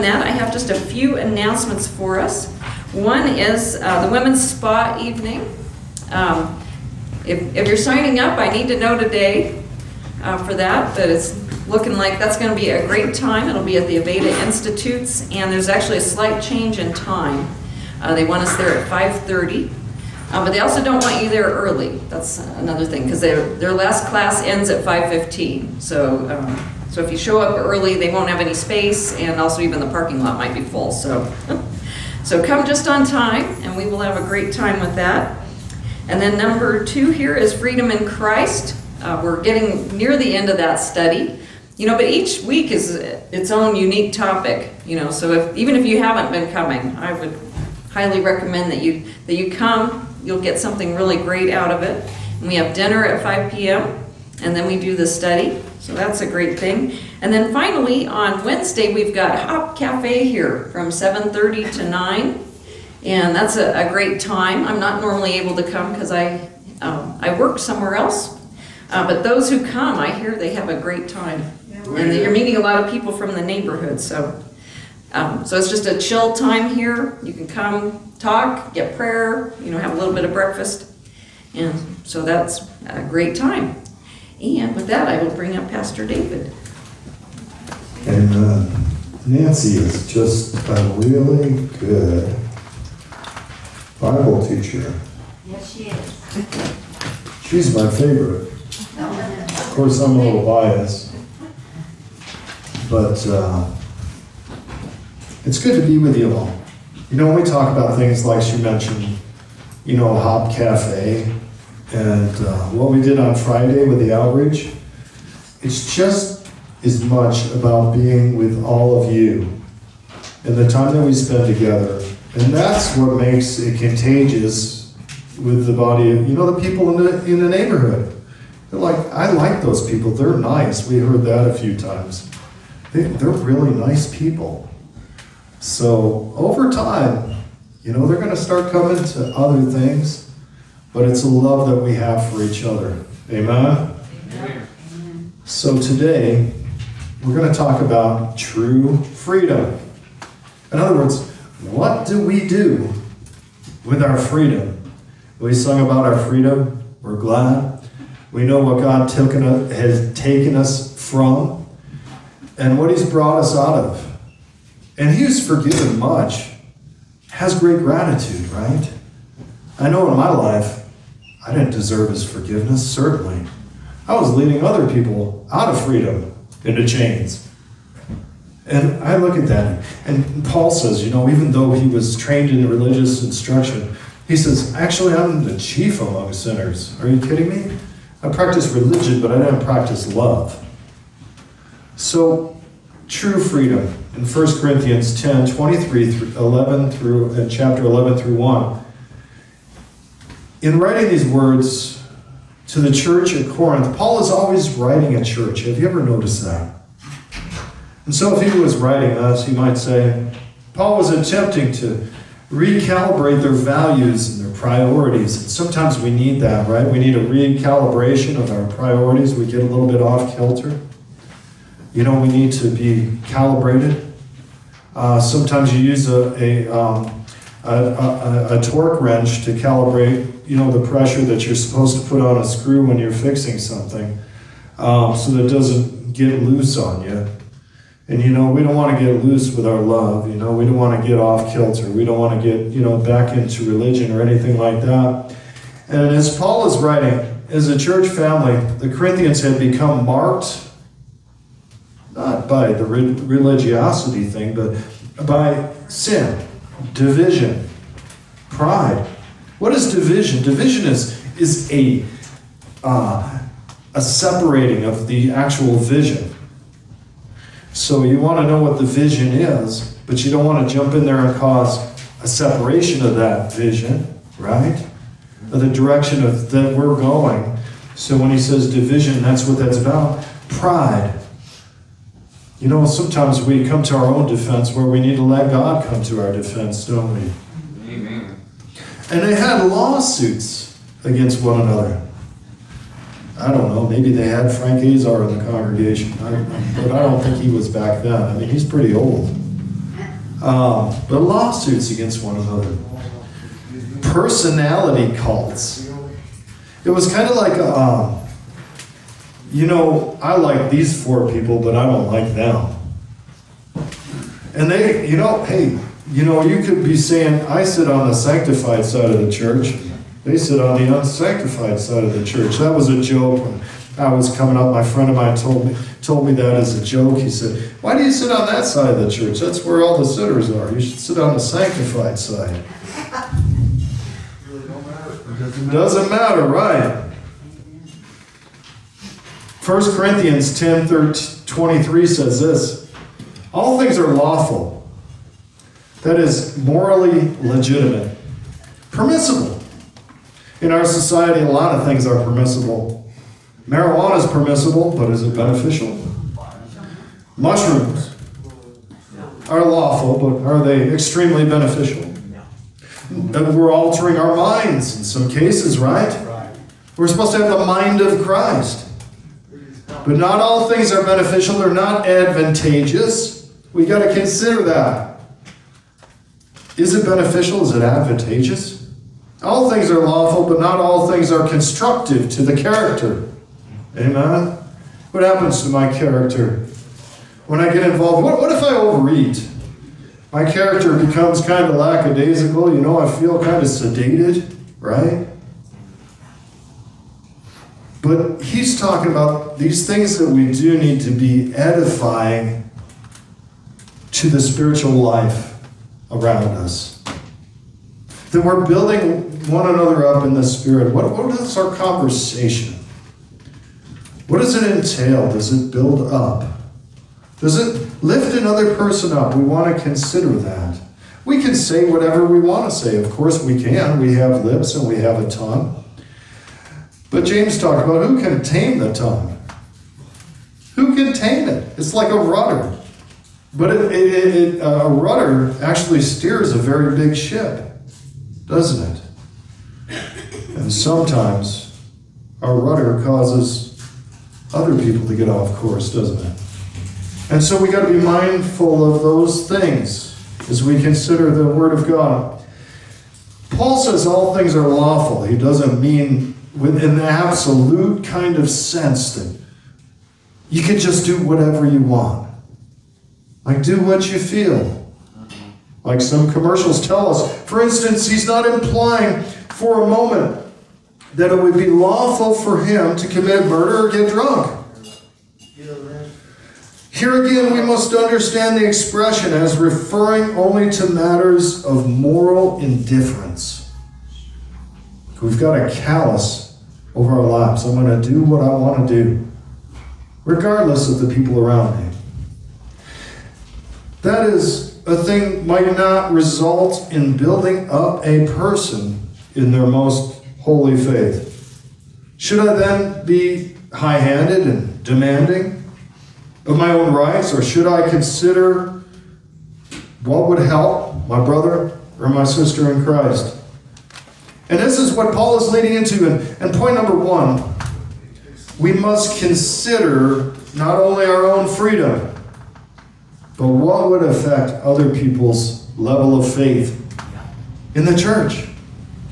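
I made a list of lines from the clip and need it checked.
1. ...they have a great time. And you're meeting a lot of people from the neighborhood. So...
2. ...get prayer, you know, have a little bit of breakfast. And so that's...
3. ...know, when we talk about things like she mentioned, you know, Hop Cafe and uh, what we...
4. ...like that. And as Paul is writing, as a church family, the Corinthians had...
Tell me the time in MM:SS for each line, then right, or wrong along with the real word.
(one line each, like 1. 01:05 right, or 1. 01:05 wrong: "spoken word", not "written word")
1. 01:10 right
2. 01:18 right
3. 01:47 right
4. 04:04 right.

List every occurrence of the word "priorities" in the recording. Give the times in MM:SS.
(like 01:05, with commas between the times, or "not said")
03:34, 03:38.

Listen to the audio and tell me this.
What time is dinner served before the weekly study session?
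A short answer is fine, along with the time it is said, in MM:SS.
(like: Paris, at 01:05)
5 p.m., at 00:53.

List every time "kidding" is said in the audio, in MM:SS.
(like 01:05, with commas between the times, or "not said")
03:07.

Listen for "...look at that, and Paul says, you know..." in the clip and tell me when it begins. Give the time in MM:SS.
02:59.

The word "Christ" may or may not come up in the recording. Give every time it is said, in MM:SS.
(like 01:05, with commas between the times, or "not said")
00:38, 06:08, 08:32.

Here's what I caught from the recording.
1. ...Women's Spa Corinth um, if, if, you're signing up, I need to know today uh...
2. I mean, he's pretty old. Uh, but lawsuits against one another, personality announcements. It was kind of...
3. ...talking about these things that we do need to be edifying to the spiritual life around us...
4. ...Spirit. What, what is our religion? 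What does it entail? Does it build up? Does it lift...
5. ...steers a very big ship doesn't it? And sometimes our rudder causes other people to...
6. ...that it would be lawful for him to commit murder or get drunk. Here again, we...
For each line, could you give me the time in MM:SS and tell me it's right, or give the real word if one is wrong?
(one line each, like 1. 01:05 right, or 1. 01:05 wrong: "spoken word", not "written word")
1. 00:04 wrong: "Evening", not "Corinth"
2. 04:58 wrong: "cults", not "announcements"
3. 06:38 right
4. 06:50 wrong: "conversation", not "religion"
5. 07:16 right
6. 07:51 right.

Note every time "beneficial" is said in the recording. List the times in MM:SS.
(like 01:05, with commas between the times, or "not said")
05:55, 06:01, 06:11, 06:17.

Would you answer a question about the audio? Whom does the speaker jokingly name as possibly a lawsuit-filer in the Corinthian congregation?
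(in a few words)
Frank Azar.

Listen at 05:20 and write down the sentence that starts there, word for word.
They sit on the unsanctified side of the church.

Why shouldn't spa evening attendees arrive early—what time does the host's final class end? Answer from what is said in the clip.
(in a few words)
5:15.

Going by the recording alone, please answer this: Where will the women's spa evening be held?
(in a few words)
Aveda Institutes.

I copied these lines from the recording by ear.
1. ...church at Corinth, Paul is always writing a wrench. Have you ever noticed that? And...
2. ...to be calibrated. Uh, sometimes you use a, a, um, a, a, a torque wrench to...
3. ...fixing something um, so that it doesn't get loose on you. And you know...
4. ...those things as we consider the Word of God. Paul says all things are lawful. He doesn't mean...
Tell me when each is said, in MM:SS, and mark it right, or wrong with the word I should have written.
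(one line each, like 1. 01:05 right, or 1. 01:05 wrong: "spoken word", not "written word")
1. 03:22 wrong: "church", not "wrench"
2. 03:42 right
3. 03:53 right
4. 07:29 right.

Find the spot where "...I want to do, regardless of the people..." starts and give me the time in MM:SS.
08:08.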